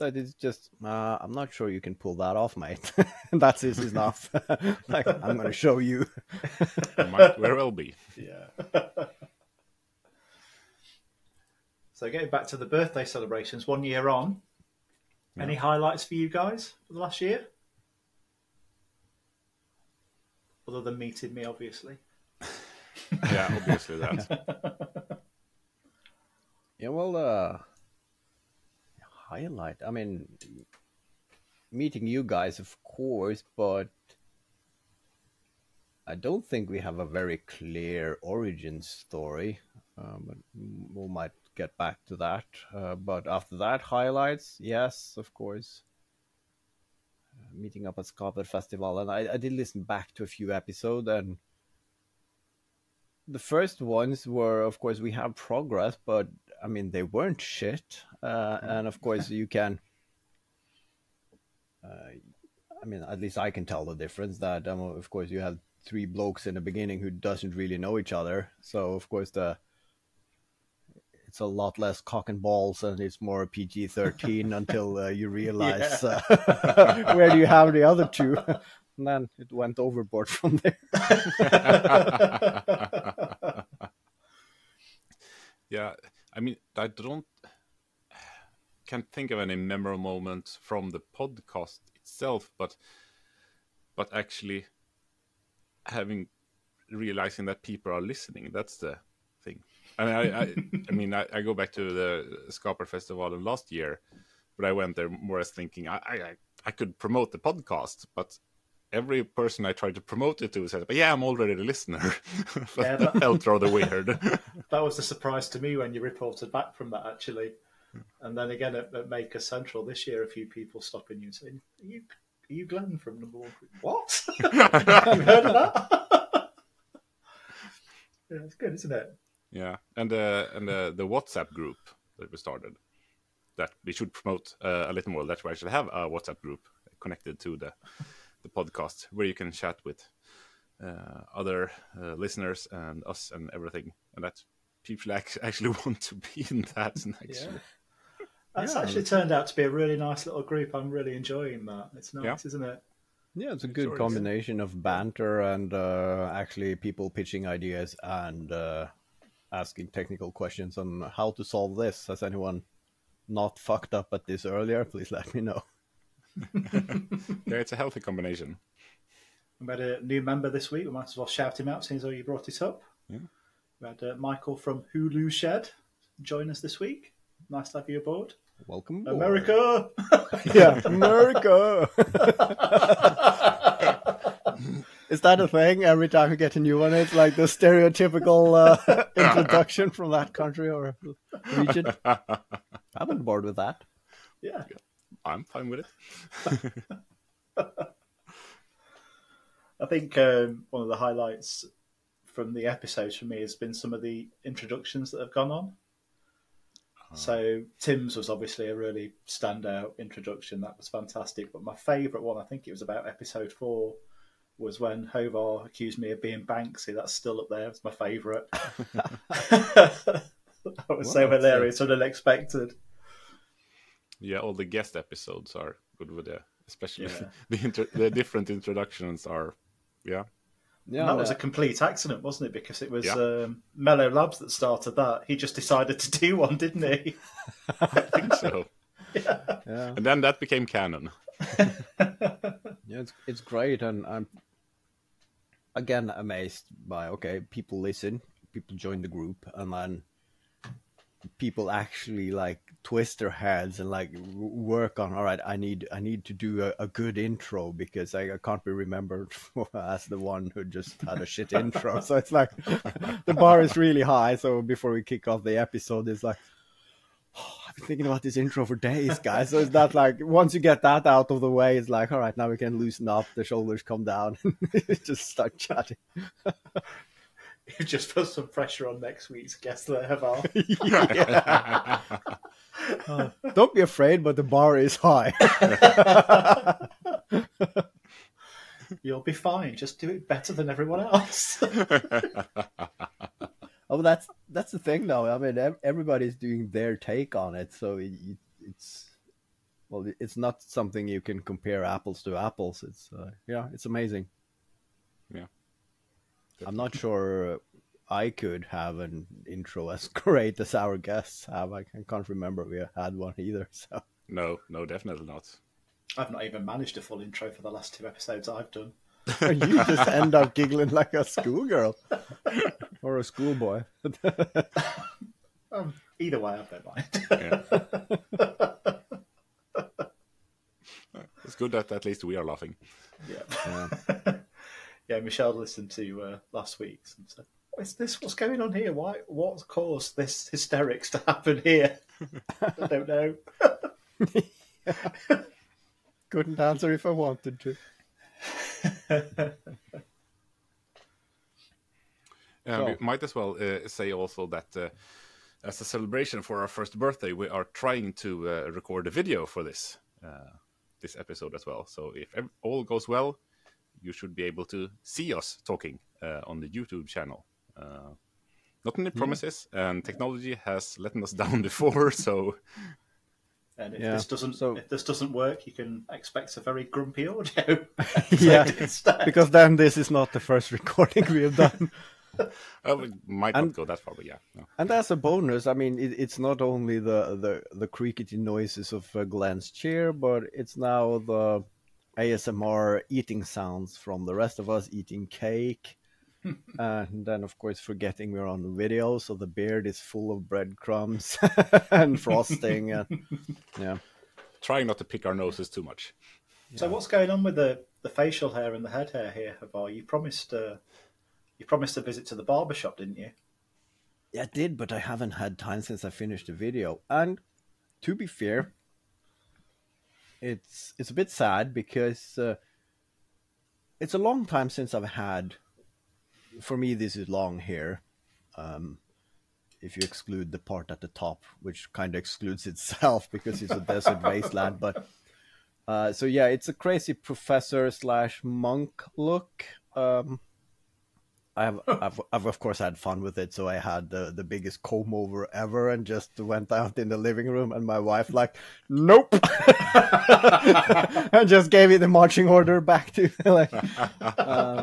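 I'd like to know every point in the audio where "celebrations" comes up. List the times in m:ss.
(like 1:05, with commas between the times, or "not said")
0:13, 5:55.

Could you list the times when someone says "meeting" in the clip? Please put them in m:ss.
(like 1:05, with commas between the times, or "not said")
0:20, 0:31, 0:47.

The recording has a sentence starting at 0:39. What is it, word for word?
Um, we might get back to that.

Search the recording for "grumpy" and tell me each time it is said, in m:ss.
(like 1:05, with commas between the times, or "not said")
6:16.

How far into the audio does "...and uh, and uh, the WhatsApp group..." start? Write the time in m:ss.
2:09.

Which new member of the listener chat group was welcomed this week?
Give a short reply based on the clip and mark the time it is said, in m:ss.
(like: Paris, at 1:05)
Michael, at 2:54.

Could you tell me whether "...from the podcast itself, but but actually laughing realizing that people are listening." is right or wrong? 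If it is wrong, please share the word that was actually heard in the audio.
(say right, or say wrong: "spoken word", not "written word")
wrong: "having", not "laughing".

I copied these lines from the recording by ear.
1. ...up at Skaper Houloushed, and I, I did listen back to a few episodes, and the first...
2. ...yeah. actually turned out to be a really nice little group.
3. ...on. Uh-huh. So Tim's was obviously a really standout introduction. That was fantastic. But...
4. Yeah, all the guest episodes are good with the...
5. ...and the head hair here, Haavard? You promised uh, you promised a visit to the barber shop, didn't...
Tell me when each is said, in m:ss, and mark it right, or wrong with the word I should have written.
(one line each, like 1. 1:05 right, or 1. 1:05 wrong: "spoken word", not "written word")
1. 0:47 wrong: "Festival", not "Houloushed"
2. 2:28 right
3. 3:25 right
4. 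3:44 right
5. 6:48 right.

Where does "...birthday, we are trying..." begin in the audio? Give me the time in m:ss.
5:56.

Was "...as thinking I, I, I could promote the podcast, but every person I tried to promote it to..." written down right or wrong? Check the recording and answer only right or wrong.
right.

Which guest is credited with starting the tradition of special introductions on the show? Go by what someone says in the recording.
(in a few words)
Mellow Labs.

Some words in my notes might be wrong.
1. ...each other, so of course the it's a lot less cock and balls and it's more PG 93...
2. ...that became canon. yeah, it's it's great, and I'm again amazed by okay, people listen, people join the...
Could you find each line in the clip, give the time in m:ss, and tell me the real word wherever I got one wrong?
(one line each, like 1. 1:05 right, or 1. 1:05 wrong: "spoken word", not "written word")
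1. 1:07 wrong: "13", not "93"
2. 4:00 right.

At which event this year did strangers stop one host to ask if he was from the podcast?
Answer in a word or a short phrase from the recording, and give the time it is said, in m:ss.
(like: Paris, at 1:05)
Maker Central, at 1:59.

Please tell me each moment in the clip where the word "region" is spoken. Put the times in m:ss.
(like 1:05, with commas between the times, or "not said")
3:11.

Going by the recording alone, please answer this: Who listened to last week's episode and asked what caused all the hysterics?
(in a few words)
Michelle.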